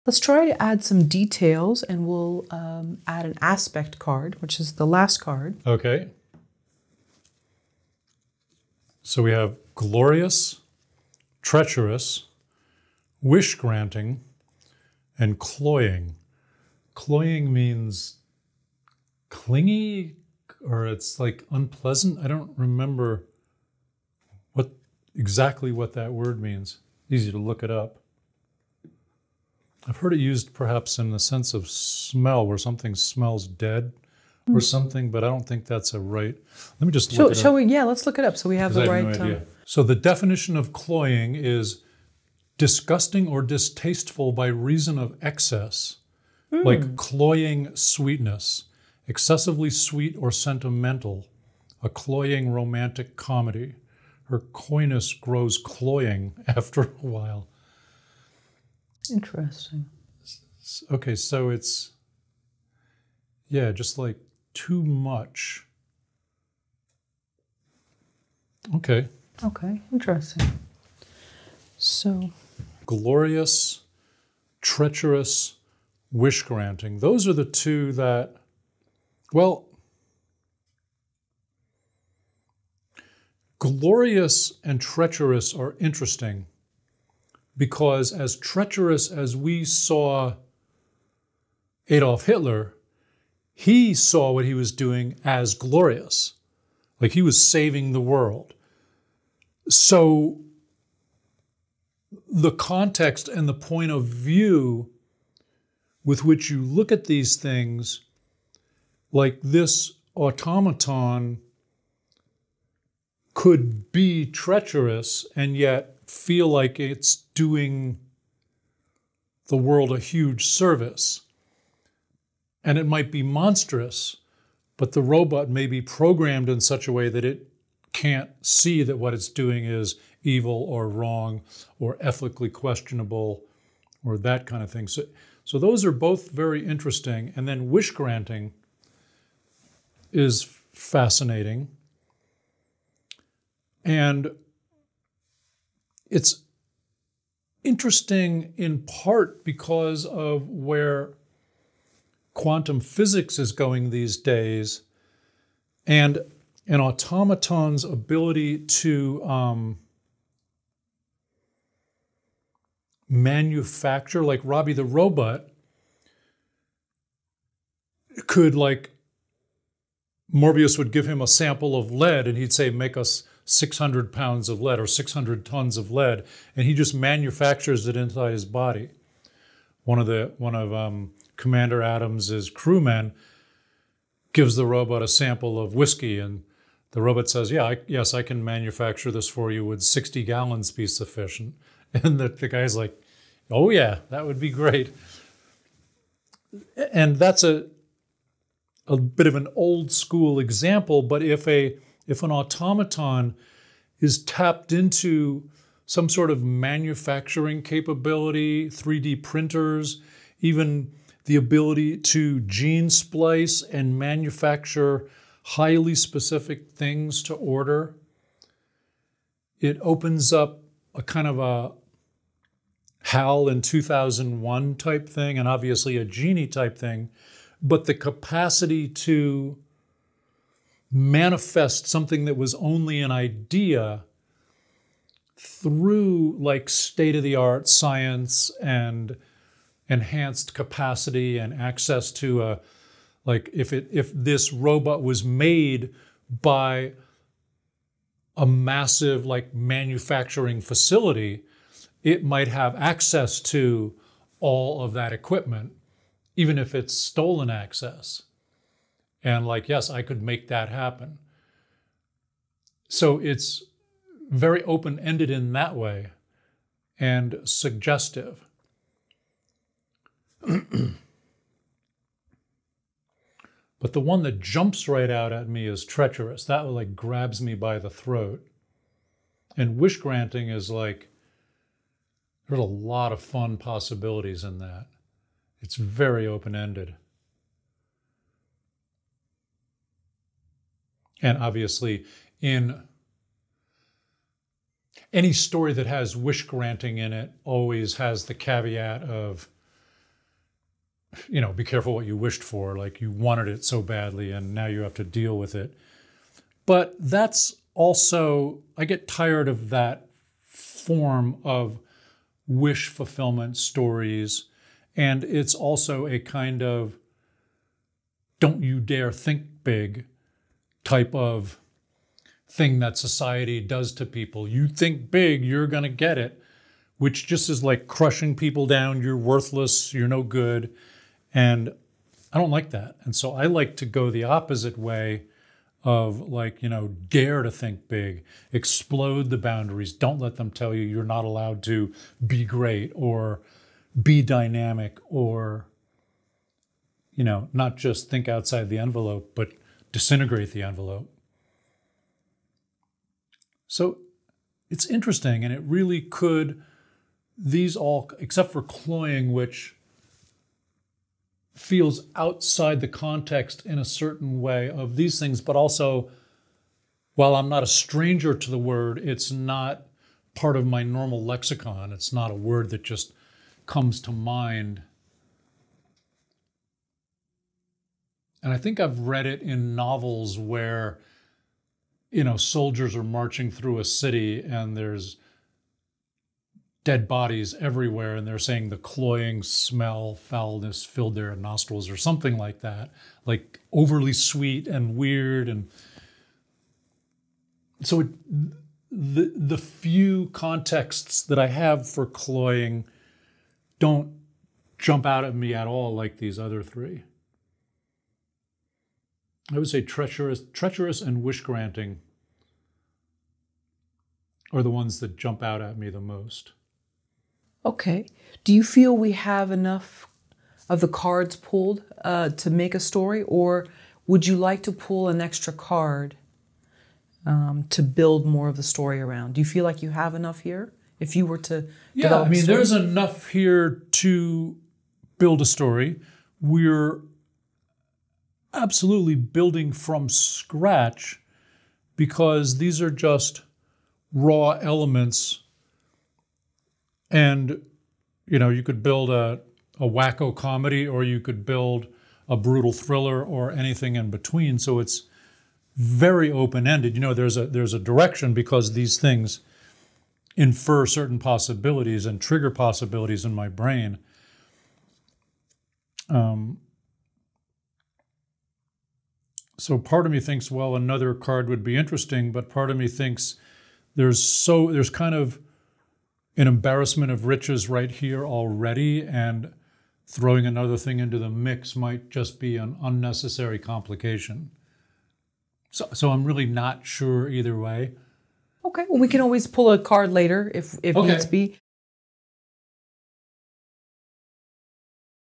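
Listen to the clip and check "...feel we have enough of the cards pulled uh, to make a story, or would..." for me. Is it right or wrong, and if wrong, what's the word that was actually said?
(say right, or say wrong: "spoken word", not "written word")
right.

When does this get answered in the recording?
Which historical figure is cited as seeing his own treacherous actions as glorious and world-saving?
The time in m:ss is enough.
1:31.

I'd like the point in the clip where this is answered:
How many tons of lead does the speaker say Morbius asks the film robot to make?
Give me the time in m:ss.
2:54.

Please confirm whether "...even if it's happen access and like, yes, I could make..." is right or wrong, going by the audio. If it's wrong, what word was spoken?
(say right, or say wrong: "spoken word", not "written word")
wrong: "stolen", not "happen".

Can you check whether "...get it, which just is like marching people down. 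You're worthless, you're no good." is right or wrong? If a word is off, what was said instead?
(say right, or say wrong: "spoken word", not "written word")
wrong: "crushing", not "marching".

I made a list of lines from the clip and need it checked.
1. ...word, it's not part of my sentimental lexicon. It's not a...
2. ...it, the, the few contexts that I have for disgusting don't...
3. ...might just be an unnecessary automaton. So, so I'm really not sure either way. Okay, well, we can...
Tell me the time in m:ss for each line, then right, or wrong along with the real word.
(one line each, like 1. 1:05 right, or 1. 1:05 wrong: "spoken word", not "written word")
1. 6:08 wrong: "normal", not "sentimental"
2. 6:37 wrong: "cloying", not "disgusting"
3. 8:01 wrong: "complication", not "automaton".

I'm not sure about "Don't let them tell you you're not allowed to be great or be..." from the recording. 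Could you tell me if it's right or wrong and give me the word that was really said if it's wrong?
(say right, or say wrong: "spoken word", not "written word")
right.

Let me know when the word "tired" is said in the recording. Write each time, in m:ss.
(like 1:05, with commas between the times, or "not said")
5:09.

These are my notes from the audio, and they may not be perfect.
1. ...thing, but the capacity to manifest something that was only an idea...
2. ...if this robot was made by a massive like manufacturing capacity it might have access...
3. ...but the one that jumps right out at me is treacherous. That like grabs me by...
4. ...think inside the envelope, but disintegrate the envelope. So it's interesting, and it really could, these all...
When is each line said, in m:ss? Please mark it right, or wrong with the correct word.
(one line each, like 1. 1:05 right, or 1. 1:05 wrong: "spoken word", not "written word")
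1. 3:46 right
2. 4:03 wrong: "facility", not "capacity"
3. 4:30 right
4. 5:48 wrong: "outside", not "inside".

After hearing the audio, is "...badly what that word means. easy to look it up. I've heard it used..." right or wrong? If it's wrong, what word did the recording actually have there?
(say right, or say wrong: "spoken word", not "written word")
wrong: "exactly", not "badly".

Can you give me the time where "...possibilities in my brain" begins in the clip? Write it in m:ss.
7:42.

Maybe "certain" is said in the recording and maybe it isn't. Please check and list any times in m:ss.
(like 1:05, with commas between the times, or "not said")
6:03, 7:40.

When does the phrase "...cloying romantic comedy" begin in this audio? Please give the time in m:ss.
0:51.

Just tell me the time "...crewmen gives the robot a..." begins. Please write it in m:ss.
3:02.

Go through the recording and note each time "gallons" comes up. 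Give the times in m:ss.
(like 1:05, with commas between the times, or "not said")
3:10.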